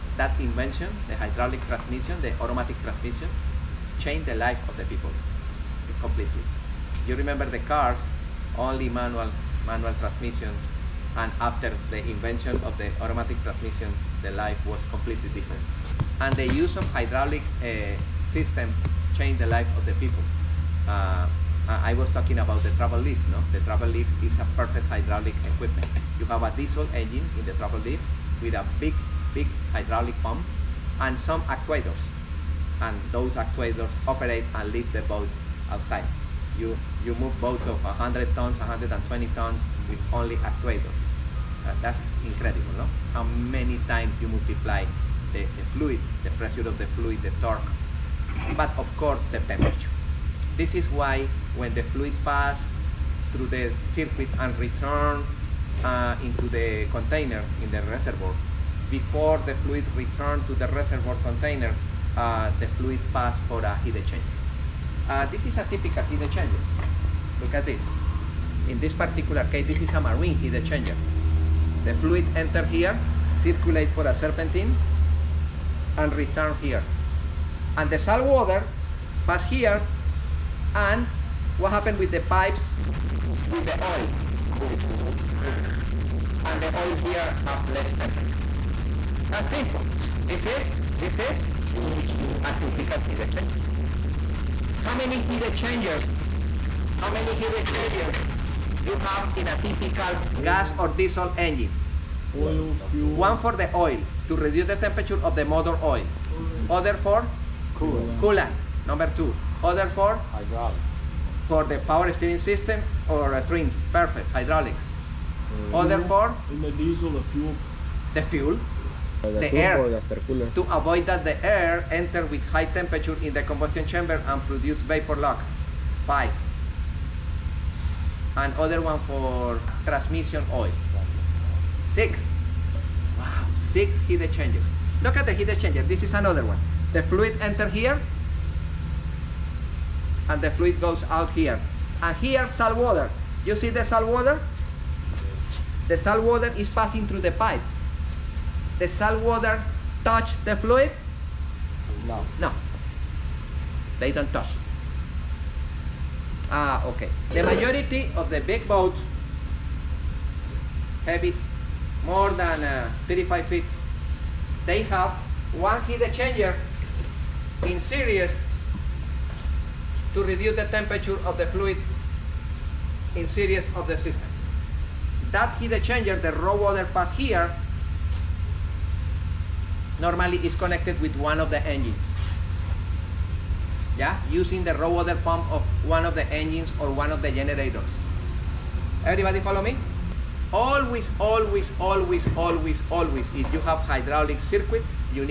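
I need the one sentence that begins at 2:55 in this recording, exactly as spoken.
That heat exchanger, the raw water pass here, normally is connected with one of the engines.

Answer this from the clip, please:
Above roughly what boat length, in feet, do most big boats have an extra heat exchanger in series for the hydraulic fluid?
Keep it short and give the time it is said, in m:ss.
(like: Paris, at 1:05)
35 feet, at 2:43.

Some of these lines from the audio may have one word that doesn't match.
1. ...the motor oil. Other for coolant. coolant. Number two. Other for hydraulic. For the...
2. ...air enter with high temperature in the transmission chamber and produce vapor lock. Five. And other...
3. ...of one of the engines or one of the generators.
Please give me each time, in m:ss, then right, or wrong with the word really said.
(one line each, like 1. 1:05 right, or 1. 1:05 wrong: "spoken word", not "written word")
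1. 1:45 right
2. 2:01 wrong: "combustion", not "transmission"
3. 3:05 right.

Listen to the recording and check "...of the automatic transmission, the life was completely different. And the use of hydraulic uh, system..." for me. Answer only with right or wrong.
right.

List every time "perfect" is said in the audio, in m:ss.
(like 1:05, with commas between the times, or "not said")
0:24, 1:53.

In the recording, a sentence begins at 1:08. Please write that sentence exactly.
In this particular case, this is a marine heat exchanger.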